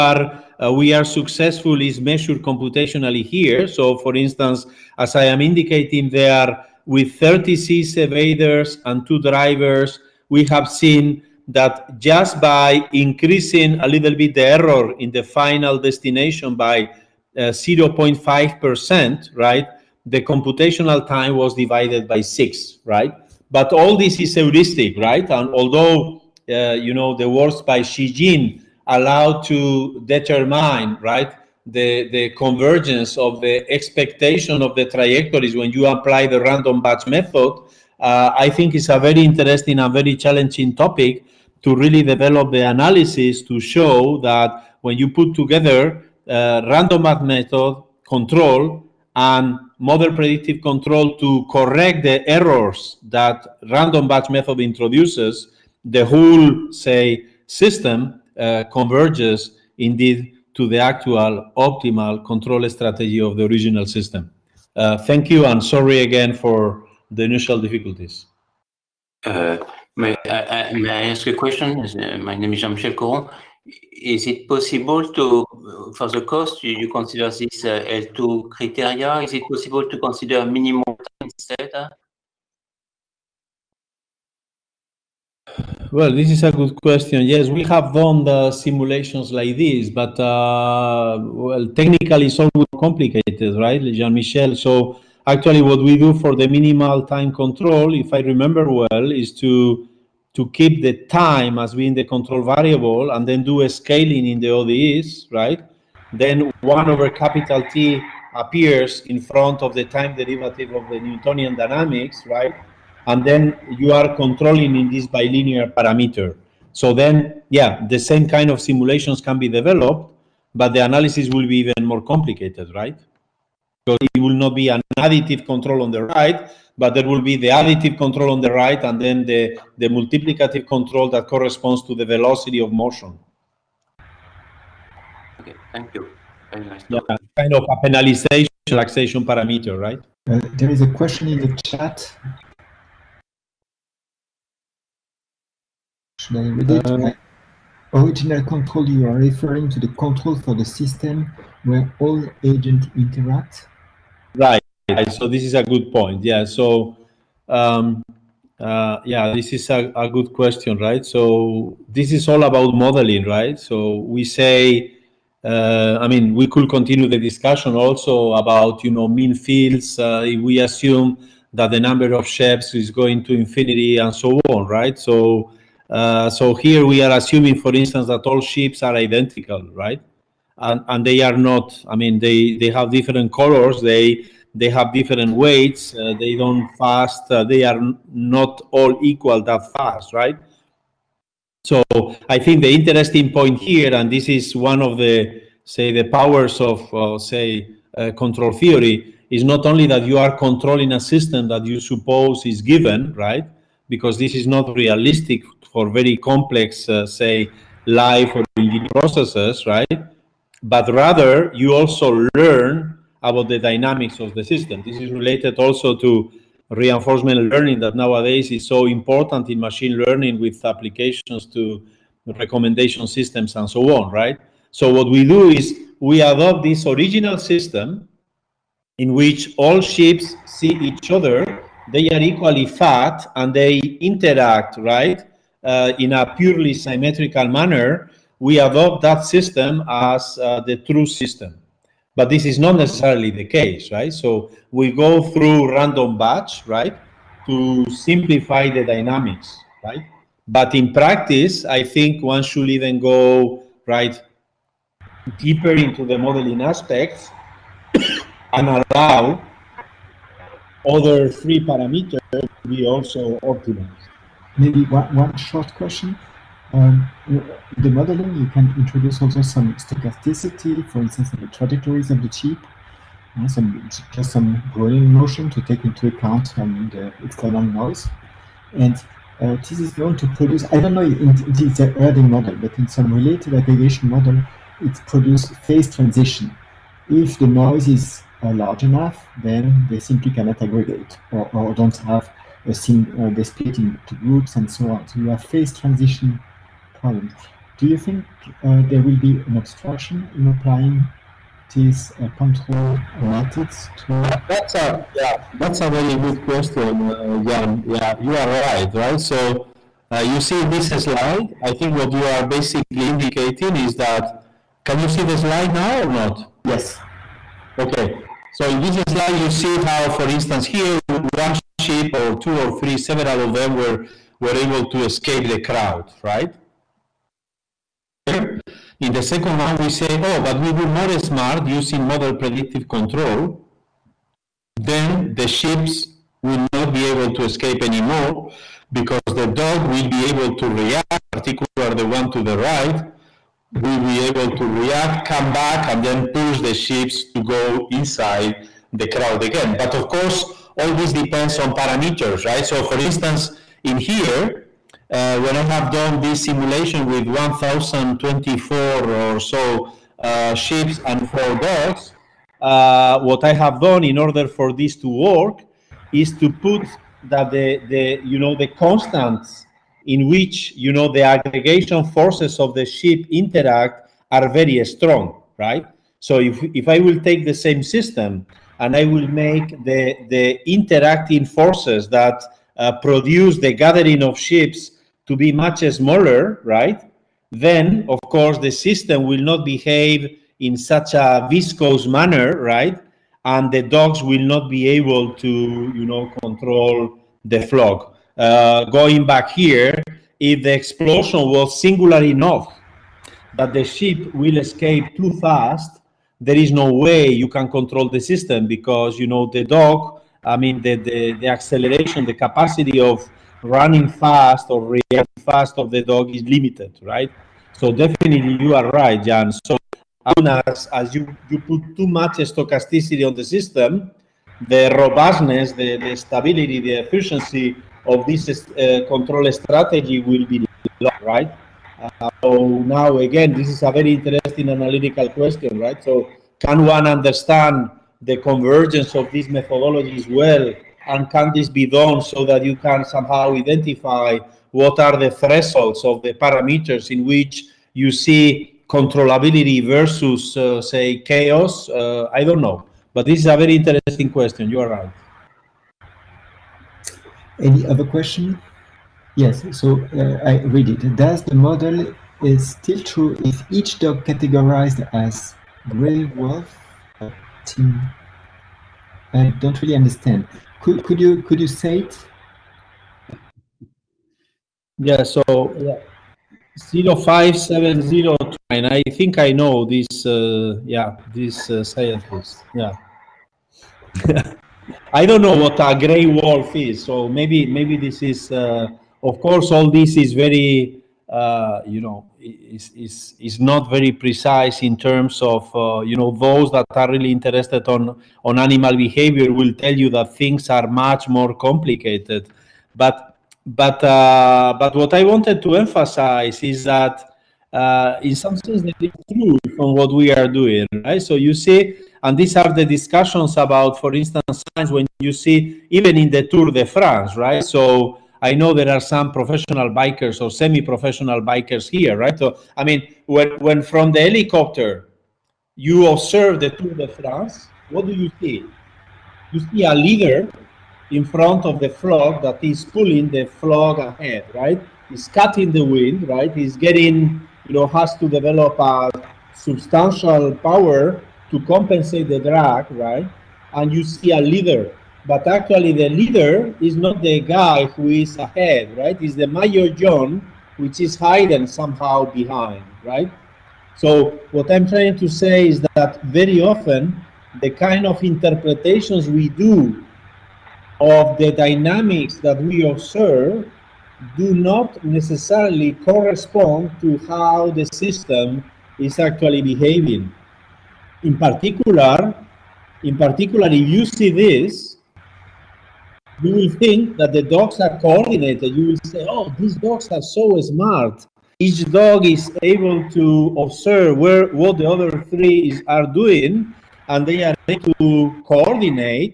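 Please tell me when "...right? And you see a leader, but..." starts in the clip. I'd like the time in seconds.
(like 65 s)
542 s.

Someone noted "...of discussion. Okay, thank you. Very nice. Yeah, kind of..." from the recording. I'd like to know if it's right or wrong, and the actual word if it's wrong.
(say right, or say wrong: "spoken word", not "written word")
wrong: "motion", not "discussion".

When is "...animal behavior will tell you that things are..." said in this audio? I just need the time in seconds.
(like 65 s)
498 s.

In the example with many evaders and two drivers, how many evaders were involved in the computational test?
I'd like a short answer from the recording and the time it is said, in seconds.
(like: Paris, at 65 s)
36, at 7 s.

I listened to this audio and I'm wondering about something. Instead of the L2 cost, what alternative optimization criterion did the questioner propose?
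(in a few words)
minimum time.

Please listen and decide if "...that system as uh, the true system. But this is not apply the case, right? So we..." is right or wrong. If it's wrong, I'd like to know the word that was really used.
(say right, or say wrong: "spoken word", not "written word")
wrong: "necessarily", not "apply".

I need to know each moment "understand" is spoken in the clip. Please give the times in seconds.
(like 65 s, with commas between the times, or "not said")
437 s, 469 s.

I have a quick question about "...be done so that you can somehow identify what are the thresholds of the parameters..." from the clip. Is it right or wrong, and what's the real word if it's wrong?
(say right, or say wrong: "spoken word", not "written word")
right.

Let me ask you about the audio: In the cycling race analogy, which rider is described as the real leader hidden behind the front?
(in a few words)
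maillot jaune.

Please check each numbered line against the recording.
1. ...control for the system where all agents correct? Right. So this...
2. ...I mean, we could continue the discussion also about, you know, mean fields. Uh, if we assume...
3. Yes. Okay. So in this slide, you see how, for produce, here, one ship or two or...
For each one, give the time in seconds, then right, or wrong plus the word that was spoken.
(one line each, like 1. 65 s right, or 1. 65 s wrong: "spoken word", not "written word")
1. 149 s wrong: "interact", not "correct"
2. 166 s right
3. 316 s wrong: "instance", not "produce".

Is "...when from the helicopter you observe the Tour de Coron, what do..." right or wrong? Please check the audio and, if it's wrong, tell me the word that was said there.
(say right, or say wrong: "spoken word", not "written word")
wrong: "France", not "Coron".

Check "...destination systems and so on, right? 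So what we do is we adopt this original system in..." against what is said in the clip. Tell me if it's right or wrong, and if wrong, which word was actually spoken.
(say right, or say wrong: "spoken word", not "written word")
wrong: "recommendation", not "destination".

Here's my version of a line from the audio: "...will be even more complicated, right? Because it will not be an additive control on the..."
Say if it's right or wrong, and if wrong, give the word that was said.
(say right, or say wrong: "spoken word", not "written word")
right.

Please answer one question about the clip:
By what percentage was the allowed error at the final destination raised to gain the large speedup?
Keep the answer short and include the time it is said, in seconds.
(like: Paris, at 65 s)
0.5%, at 17 s.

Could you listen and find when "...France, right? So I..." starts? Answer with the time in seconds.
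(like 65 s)
516 s.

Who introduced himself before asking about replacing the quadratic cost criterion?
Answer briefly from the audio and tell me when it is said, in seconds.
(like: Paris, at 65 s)
Jean-Michel Coron, at 72 s.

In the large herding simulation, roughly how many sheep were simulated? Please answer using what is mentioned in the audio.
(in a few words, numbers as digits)
1,024.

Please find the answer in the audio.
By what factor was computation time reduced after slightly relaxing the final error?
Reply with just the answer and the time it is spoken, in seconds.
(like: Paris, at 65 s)
6, at 21 s.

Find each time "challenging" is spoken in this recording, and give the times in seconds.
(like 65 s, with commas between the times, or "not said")
40 s.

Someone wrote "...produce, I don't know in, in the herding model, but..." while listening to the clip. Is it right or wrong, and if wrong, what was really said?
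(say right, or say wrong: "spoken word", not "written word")
right.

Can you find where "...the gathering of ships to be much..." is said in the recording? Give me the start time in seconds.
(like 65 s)
383 s.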